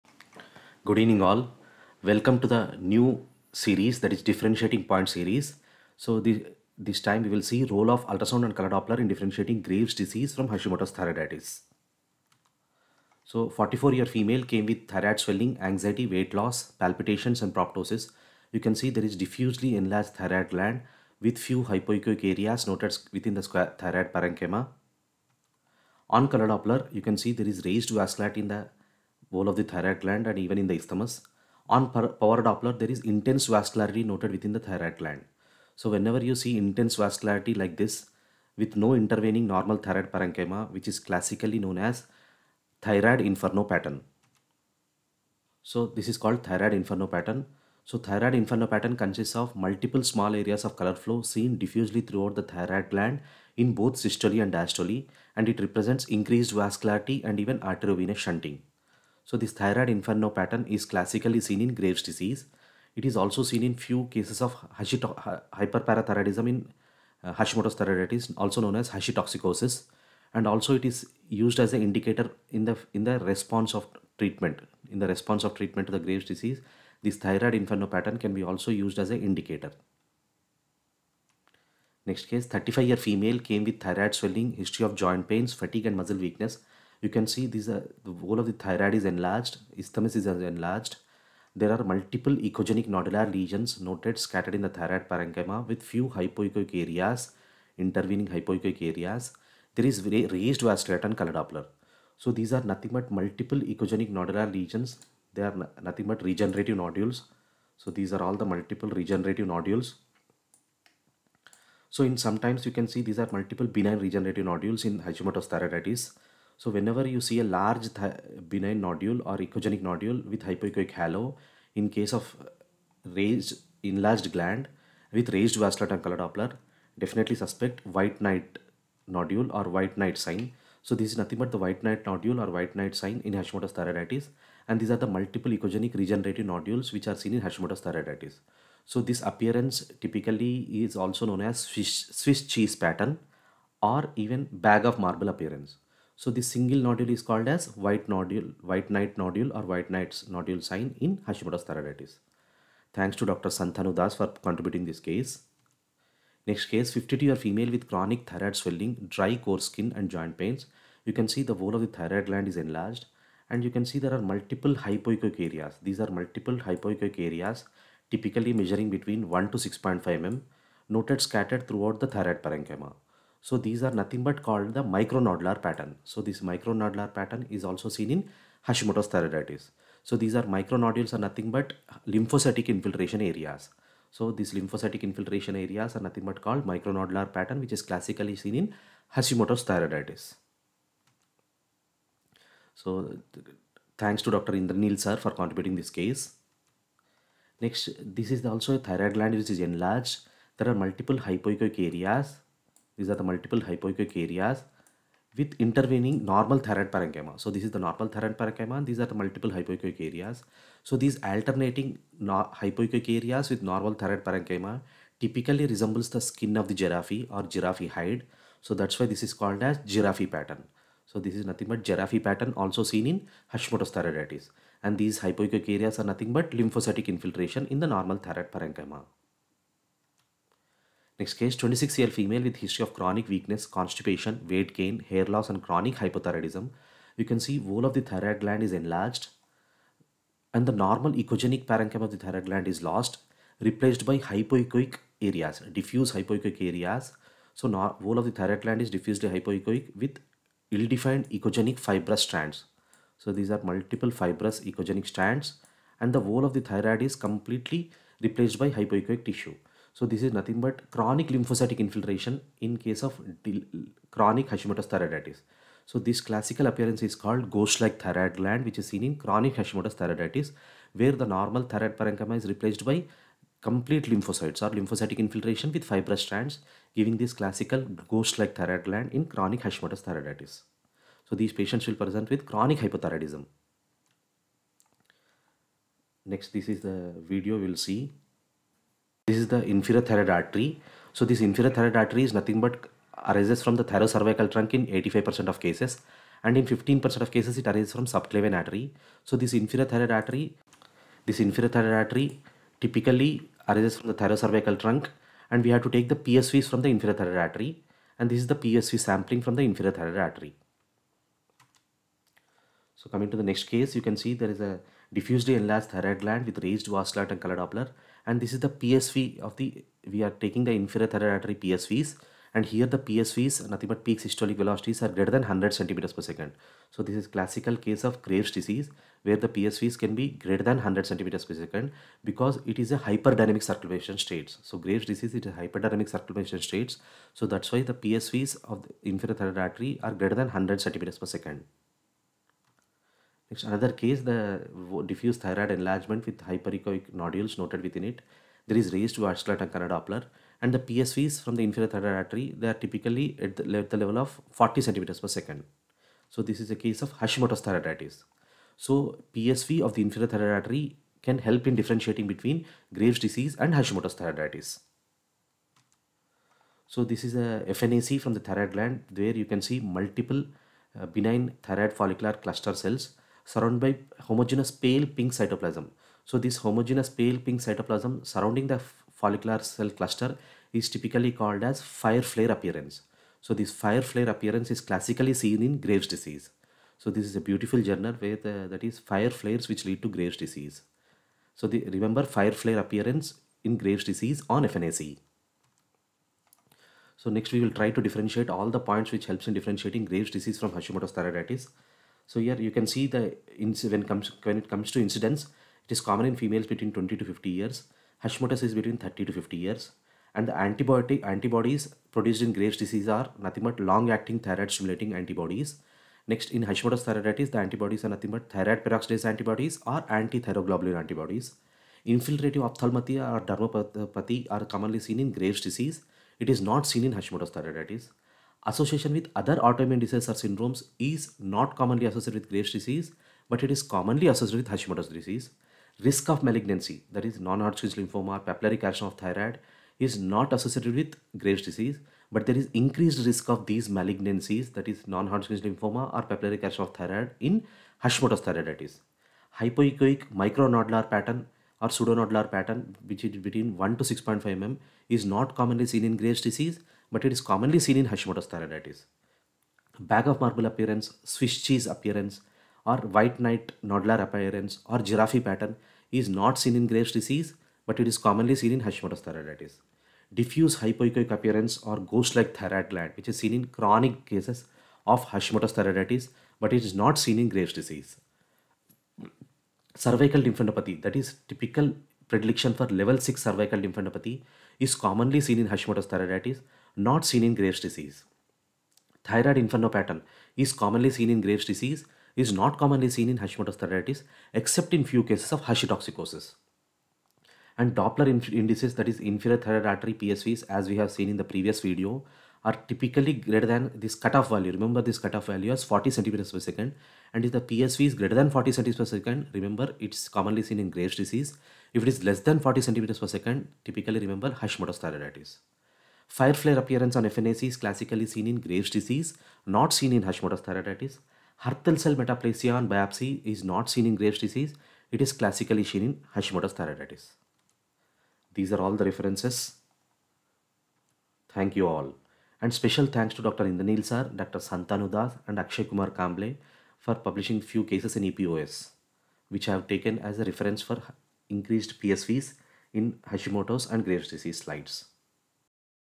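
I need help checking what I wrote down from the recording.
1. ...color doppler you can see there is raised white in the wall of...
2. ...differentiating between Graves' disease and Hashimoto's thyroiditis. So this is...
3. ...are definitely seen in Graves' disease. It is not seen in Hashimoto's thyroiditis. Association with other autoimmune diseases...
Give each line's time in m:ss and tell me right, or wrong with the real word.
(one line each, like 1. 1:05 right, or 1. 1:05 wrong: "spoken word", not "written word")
1. 0:26 wrong: "vasculite", not "white"
2. 6:01 right
3. 7:04 wrong: "commonly", not "definitely".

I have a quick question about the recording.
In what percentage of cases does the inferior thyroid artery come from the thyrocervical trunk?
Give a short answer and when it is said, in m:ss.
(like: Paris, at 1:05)
85%, at 4:54.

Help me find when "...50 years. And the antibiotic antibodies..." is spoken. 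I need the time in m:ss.
6:49.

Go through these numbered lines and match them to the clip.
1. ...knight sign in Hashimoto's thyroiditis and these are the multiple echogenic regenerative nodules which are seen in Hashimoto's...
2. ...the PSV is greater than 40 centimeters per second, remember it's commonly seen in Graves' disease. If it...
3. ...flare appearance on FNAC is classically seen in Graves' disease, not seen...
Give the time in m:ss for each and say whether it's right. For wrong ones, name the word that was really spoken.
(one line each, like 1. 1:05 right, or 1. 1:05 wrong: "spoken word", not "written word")
1. 2:12 right
2. 8:27 right
3. 8:36 right.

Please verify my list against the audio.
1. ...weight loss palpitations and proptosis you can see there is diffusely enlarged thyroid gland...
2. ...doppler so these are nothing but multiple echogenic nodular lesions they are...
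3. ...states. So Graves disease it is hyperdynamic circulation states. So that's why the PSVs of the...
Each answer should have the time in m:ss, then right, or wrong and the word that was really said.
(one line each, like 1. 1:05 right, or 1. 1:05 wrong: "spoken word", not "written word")
1. 0:16 right
2. 1:41 right
3. 5:34 right.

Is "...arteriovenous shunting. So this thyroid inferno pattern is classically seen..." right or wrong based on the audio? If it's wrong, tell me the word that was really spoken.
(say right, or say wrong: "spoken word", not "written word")
right.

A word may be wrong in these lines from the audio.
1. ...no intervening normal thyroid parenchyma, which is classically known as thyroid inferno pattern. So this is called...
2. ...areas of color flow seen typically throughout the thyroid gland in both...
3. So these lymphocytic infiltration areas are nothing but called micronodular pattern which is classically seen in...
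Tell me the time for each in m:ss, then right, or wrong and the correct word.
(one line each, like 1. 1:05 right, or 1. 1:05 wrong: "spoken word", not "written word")
1. 0:38 right
2. 0:50 wrong: "diffusely", not "typically"
3. 3:04 right.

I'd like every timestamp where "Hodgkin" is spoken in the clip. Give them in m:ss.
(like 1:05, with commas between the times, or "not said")
7:17, 7:25.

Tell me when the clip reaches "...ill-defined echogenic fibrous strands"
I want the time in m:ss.
4:10.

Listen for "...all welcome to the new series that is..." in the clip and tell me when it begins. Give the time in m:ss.
0:01.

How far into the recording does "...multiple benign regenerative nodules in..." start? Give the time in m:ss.
1:53.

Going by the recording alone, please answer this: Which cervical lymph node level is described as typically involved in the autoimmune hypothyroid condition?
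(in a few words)
Level 6.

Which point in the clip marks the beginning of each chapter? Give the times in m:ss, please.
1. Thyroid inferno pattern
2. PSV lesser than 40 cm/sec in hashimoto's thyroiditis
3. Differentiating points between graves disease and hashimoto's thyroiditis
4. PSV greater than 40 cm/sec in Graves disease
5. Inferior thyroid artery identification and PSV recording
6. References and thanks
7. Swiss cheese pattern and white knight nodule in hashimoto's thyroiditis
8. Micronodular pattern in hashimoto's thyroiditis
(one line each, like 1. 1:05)
1. 0:48
2. 5:53
3. 6:44
4. 5:25
5. 5:03
6. 8:48
7. 2:00
8. 3:00.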